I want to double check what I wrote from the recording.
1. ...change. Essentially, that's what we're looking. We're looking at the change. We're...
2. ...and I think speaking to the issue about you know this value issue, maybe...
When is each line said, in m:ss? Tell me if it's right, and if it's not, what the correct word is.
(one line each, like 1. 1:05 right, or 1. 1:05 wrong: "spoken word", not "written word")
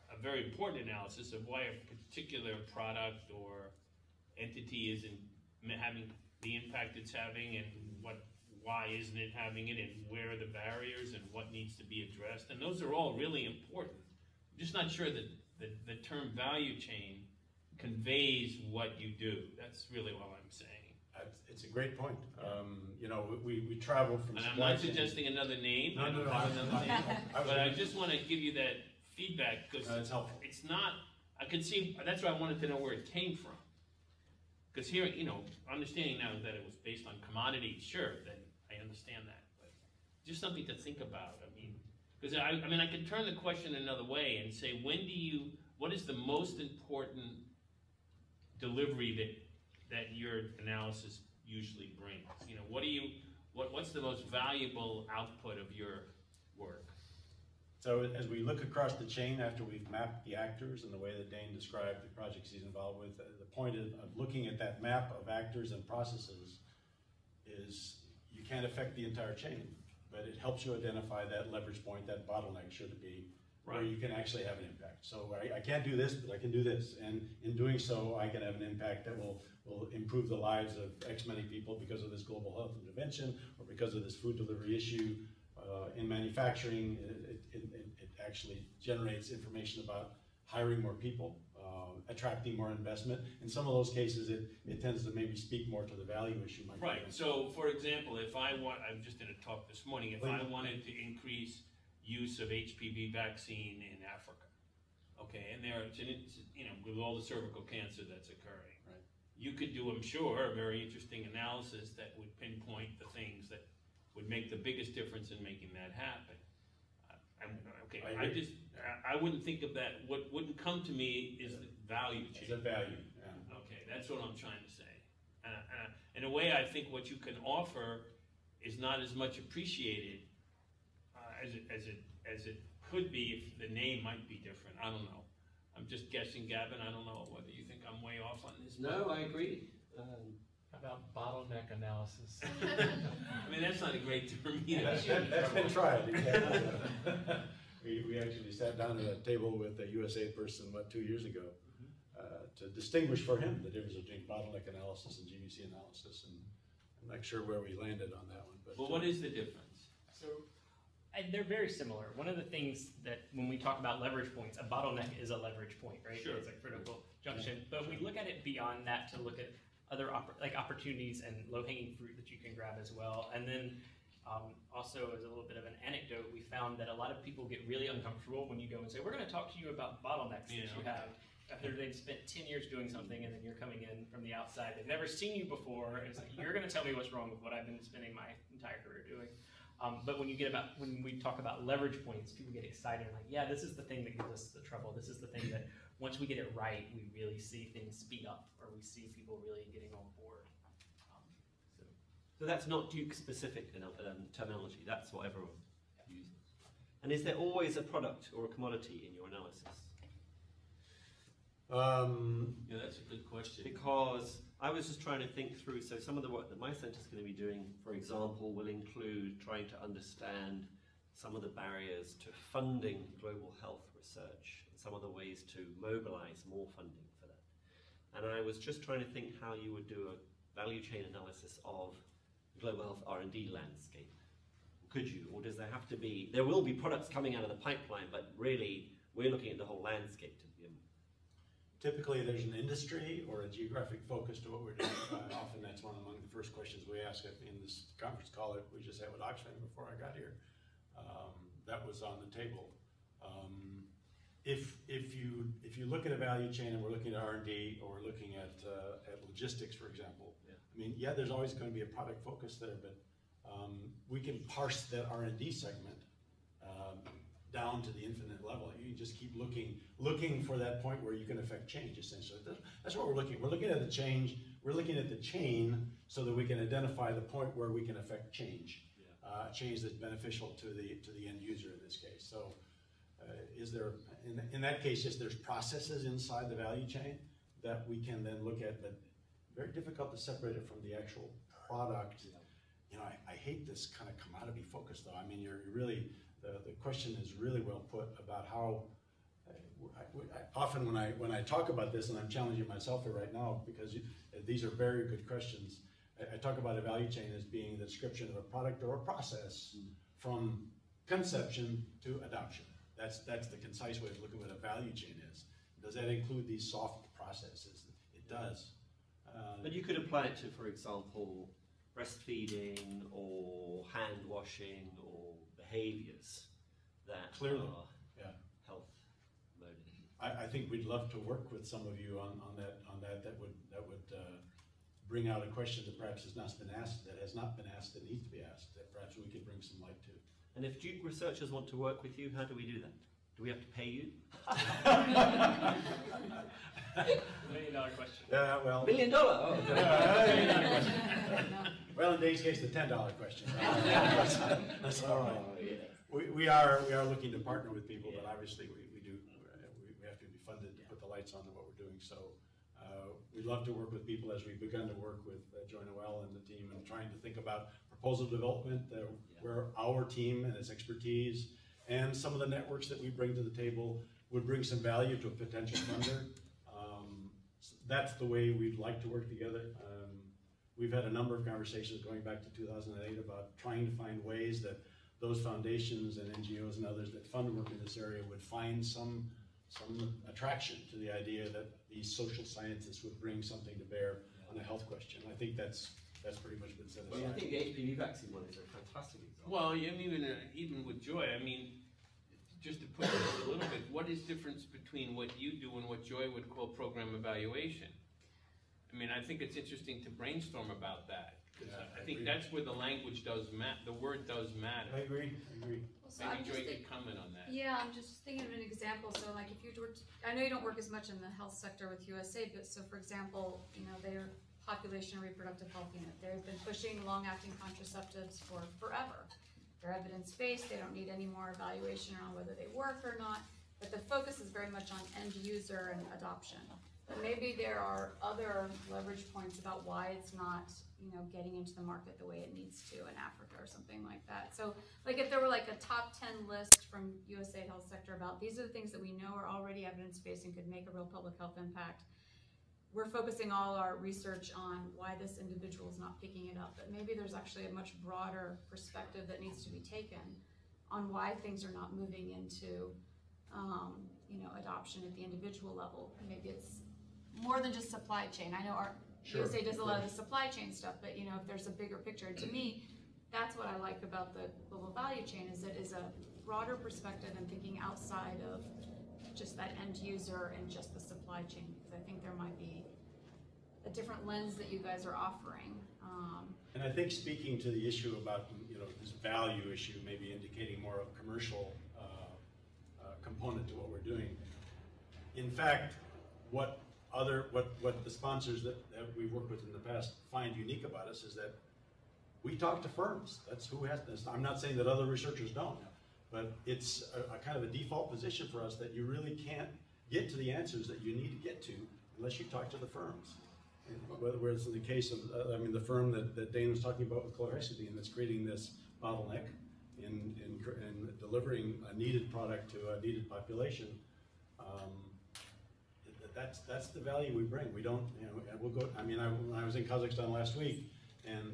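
1. 4:31 right
2. 8:06 right.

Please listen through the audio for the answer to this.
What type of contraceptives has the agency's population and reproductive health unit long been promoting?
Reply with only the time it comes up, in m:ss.
7:07.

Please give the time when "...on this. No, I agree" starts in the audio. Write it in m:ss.
2:18.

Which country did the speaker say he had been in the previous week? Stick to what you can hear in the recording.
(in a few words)
Kazakhstan.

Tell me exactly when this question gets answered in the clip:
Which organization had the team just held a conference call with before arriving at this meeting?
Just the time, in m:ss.
4:09.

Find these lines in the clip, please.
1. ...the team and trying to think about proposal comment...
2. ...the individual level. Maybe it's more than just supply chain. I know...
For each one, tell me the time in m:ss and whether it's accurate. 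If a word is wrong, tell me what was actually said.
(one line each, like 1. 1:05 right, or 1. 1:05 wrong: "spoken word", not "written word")
1. 6:06 wrong: "development", not "comment"
2. 7:45 right.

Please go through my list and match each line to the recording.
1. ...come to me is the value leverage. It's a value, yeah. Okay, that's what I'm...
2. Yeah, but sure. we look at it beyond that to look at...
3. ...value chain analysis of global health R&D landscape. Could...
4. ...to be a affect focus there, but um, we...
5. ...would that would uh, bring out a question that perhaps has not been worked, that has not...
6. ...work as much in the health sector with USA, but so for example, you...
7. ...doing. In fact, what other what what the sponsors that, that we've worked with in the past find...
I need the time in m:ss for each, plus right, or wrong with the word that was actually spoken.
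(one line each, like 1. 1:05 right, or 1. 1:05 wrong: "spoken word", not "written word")
1. 2:00 wrong: "change", not "leverage"
2. 2:47 right
3. 3:50 right
4. 4:21 wrong: "product", not "affect"
5. 5:33 wrong: "asked", not "worked"
6. 7:00 right
7. 8:13 right.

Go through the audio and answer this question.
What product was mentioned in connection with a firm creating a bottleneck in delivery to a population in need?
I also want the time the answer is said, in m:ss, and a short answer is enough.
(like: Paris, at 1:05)
Chlorhexidine, at 8:37.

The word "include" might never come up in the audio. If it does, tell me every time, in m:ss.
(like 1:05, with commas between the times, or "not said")
3:38, 5:16.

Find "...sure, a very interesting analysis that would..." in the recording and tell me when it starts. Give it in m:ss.
1:50.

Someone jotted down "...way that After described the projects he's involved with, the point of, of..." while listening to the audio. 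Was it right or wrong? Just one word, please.
wrong.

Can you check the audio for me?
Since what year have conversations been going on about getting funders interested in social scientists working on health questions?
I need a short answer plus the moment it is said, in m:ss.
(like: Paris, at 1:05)
2008, at 6:22.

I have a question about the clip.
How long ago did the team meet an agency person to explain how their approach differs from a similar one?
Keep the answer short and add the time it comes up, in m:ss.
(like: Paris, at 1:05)
Two years ago, at 2:30.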